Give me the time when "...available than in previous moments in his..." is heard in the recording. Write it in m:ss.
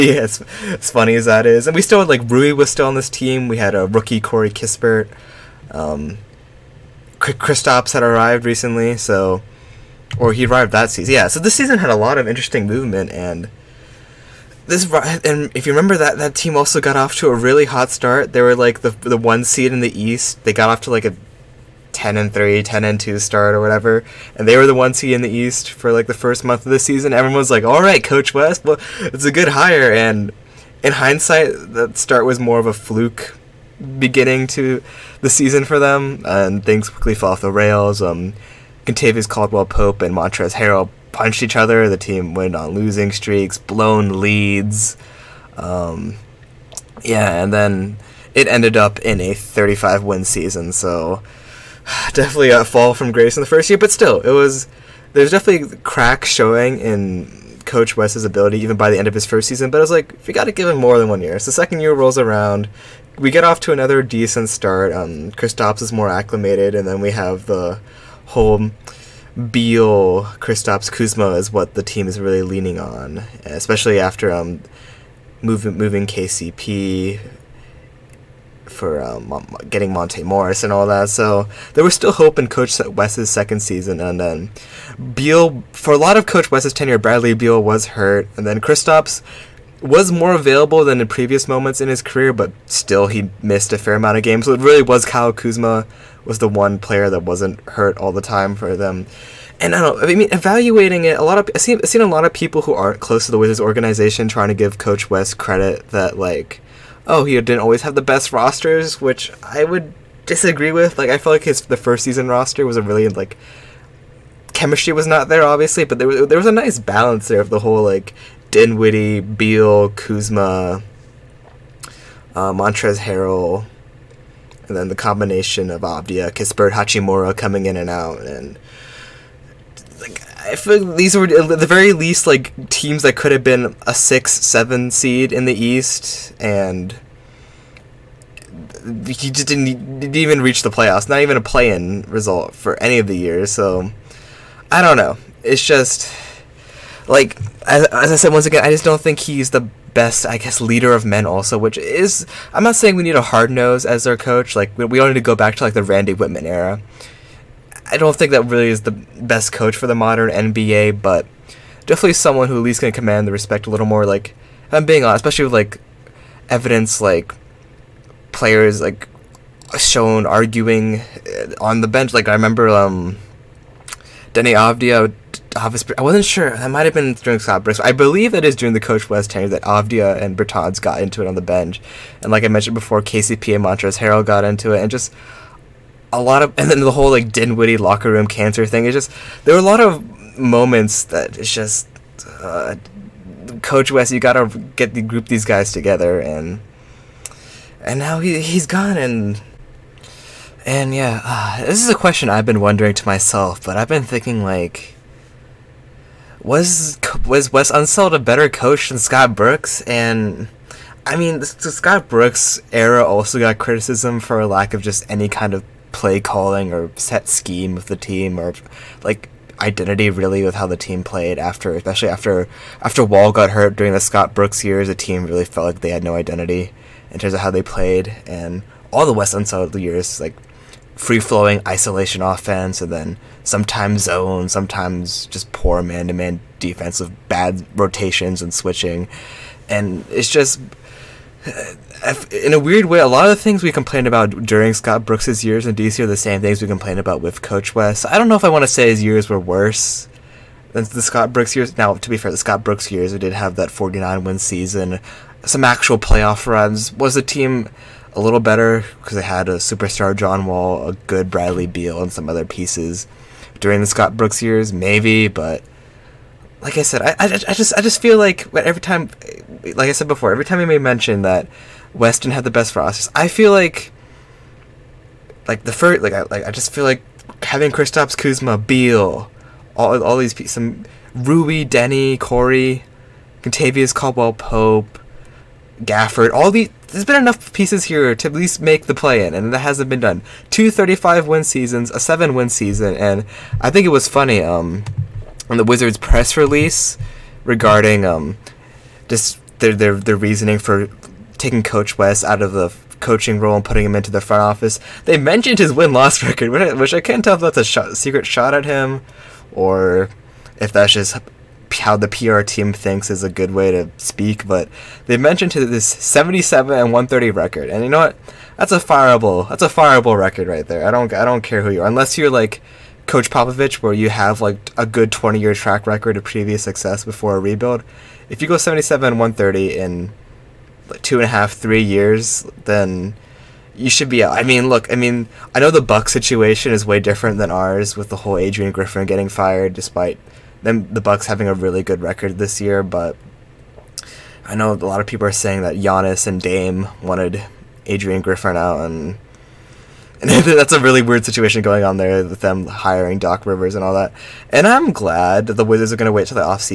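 1:30.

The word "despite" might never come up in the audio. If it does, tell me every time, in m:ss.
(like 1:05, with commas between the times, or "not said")
5:39.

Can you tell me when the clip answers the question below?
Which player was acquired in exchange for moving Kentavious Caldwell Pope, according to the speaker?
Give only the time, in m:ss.
1:19.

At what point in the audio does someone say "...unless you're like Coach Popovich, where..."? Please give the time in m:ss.
5:21.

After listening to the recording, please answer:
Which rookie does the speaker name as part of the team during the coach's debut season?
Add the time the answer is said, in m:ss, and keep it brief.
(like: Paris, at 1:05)
Corey Kispert, at 0:04.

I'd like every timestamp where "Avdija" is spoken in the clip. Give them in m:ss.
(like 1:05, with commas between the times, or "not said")
2:05, 2:54, 2:59.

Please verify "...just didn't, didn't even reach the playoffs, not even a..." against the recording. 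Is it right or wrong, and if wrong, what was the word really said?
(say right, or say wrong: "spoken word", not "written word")
right.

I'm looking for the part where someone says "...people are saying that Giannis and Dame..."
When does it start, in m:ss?
5:45.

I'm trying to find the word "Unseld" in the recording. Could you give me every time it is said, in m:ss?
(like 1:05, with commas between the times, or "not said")
3:27, 3:49.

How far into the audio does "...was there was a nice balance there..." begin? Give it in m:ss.
1:56.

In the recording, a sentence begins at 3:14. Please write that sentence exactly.
You gotta get the group these guys together, and and now he he's gone and.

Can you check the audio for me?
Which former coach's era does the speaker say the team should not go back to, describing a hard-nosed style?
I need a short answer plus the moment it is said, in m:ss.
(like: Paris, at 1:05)
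Randy Wittman, at 2:35.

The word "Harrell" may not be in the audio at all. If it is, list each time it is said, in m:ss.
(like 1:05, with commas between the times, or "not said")
0:40, 2:02, 3:03.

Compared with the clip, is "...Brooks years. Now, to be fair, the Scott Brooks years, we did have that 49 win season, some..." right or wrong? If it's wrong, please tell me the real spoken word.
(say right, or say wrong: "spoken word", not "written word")
right.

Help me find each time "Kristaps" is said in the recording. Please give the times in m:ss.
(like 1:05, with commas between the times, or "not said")
0:07, 1:05, 1:10, 1:28, 4:37.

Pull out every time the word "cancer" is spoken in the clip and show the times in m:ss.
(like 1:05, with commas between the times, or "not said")
3:08.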